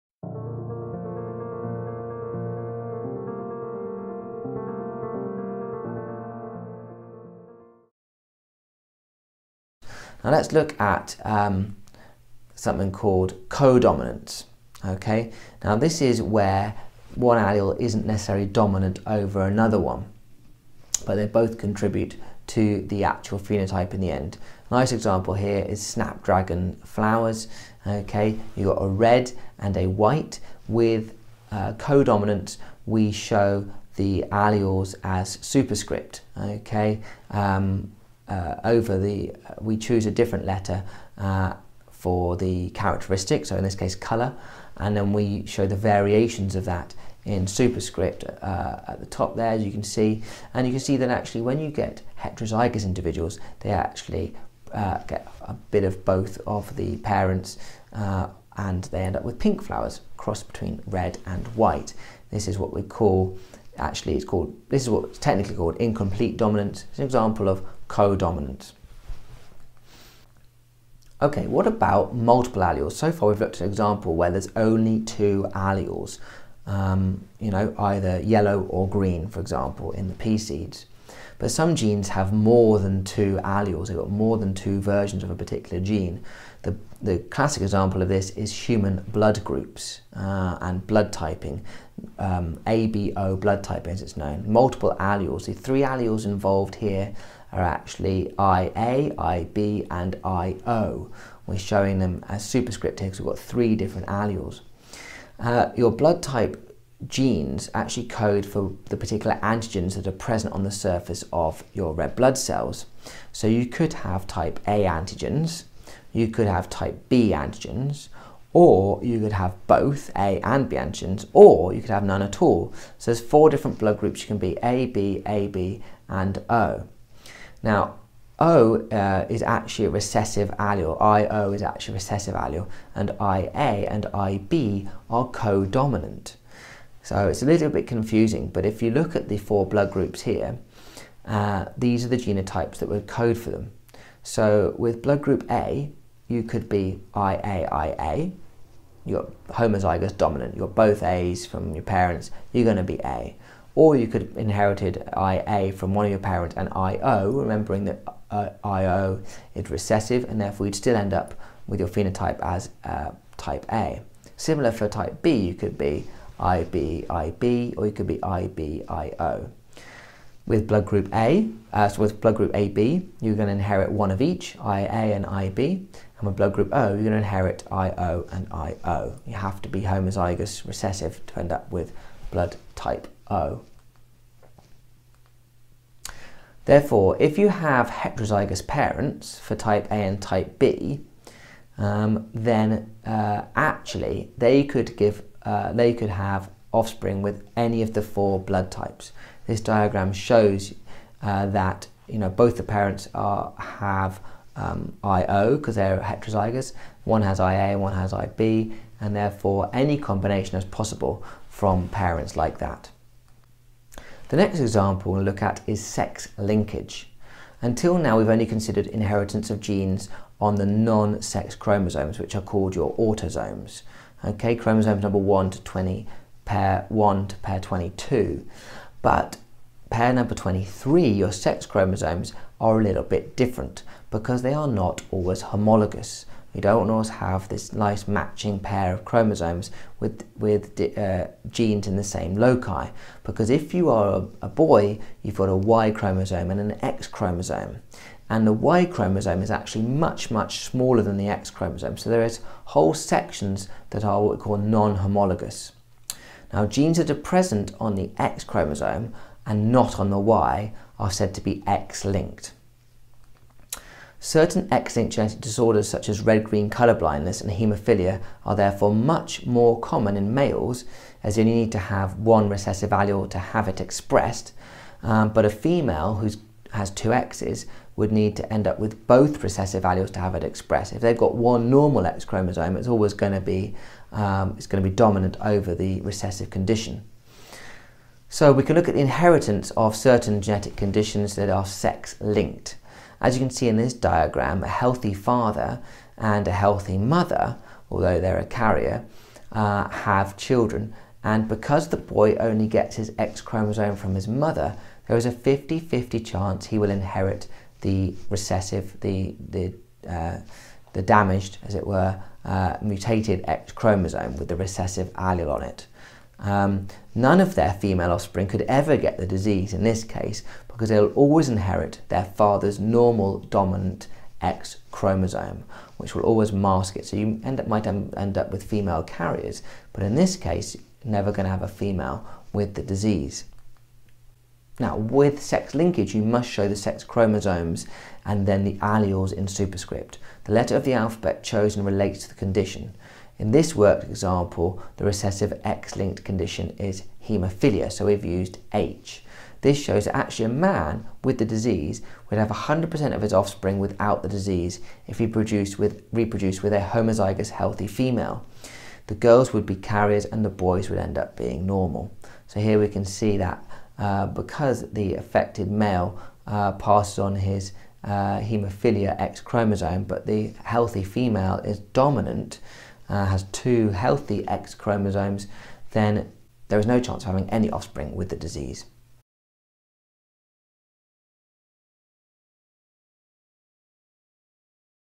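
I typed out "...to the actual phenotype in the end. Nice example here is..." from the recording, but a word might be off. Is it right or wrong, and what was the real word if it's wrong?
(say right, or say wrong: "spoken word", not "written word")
right.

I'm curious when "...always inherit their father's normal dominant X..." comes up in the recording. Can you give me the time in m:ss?
5:21.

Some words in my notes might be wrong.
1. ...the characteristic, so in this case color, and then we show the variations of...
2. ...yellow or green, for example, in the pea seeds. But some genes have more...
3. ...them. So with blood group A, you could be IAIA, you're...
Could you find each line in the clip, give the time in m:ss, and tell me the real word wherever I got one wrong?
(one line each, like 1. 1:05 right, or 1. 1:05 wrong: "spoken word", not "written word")
1. 0:42 right
2. 1:18 right
3. 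2:23 right.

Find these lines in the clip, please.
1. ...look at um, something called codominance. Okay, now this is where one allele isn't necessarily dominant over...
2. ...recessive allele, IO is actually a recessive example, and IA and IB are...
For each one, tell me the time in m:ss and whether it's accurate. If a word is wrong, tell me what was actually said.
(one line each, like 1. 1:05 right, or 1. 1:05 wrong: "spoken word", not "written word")
1. 0:10 right
2. 2:09 wrong: "allele", not "example".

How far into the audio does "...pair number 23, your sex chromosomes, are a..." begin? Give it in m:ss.
3:49.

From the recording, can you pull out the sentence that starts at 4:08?
And the Y chromosome is actually much, much smaller than the X chromosome.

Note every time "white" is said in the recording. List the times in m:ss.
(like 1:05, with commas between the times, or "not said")
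0:29, 1:01.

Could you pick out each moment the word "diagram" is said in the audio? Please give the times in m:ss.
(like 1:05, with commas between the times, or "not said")
3:19, 4:53.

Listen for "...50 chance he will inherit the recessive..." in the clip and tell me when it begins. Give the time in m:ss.
5:05.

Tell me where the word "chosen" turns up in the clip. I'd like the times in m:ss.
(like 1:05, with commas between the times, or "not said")
5:41.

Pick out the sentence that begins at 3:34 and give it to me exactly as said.
The next example we'll look at is sex linkage.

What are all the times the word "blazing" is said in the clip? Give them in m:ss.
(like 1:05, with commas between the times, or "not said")
not said.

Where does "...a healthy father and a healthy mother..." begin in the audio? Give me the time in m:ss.
4:54.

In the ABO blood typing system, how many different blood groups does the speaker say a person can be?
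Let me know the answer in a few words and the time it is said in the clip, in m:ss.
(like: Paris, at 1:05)
4, at 2:03.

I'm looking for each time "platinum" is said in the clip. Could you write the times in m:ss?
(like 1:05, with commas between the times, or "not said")
not said.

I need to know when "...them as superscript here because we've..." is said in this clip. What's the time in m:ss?
1:41.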